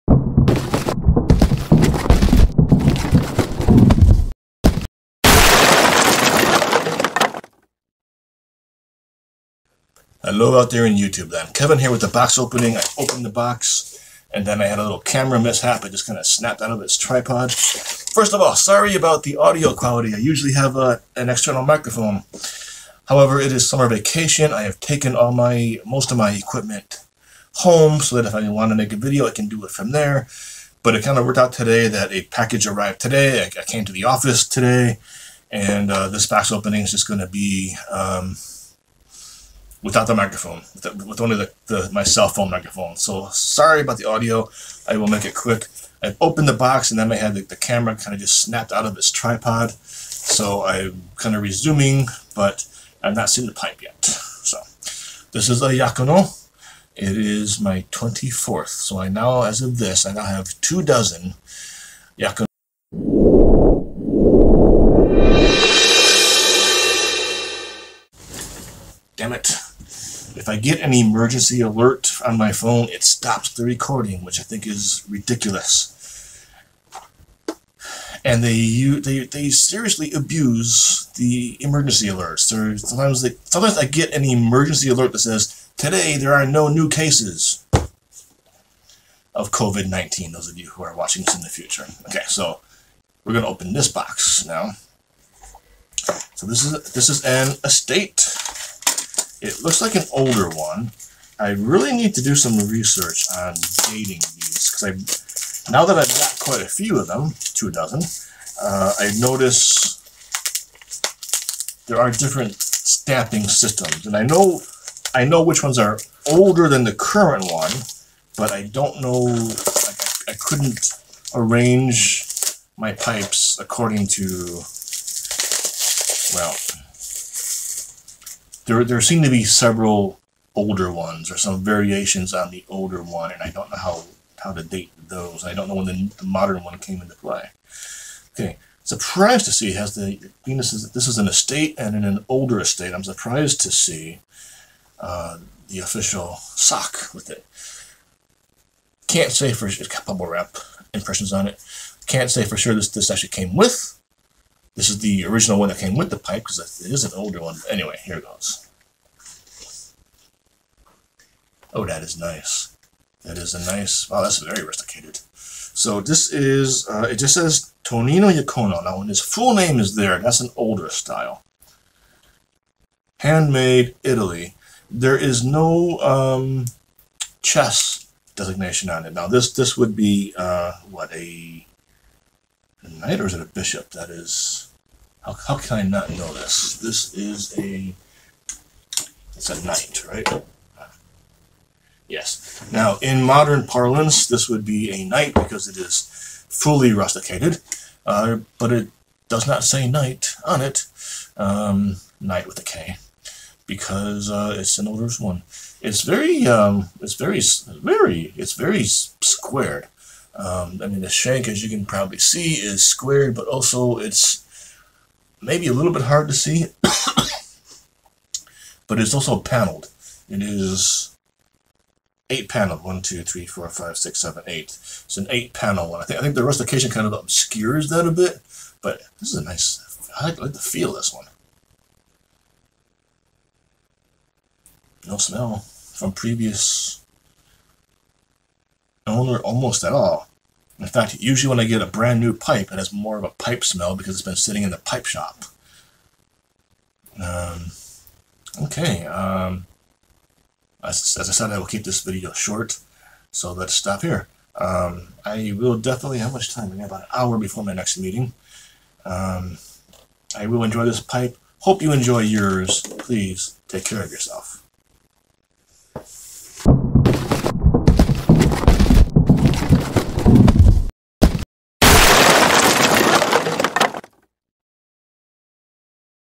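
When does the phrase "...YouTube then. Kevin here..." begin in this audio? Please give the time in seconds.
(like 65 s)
10 s.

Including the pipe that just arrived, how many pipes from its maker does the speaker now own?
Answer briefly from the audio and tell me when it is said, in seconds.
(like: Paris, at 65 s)
24, at 57 s.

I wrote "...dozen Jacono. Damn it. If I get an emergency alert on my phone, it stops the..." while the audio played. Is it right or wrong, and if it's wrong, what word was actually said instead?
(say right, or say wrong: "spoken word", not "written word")
right.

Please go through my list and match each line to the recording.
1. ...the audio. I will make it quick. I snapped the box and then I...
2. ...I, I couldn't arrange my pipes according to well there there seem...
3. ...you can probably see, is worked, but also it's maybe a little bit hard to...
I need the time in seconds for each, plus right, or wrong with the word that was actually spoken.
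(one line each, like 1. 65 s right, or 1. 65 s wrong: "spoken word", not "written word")
1. 43 s wrong: "opened", not "snapped"
2. 120 s right
3. 211 s wrong: "squared", not "worked".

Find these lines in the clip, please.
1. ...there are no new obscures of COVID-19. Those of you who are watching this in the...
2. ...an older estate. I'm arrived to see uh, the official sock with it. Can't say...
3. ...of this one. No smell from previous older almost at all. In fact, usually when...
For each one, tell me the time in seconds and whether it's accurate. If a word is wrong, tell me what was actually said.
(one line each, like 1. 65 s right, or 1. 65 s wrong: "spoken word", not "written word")
1. 86 s wrong: "cases", not "obscures"
2. 142 s wrong: "surprised", not "arrived"
3. 230 s wrong: "owner", not "older".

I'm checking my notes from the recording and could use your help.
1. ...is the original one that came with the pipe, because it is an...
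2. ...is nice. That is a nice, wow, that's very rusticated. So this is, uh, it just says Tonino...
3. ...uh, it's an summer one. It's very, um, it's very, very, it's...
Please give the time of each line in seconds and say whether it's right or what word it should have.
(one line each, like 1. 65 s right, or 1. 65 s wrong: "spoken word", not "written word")
1. 154 s right
2. 162 s right
3. 204 s wrong: "older", not "summer".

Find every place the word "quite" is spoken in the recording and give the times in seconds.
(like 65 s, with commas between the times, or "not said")
106 s.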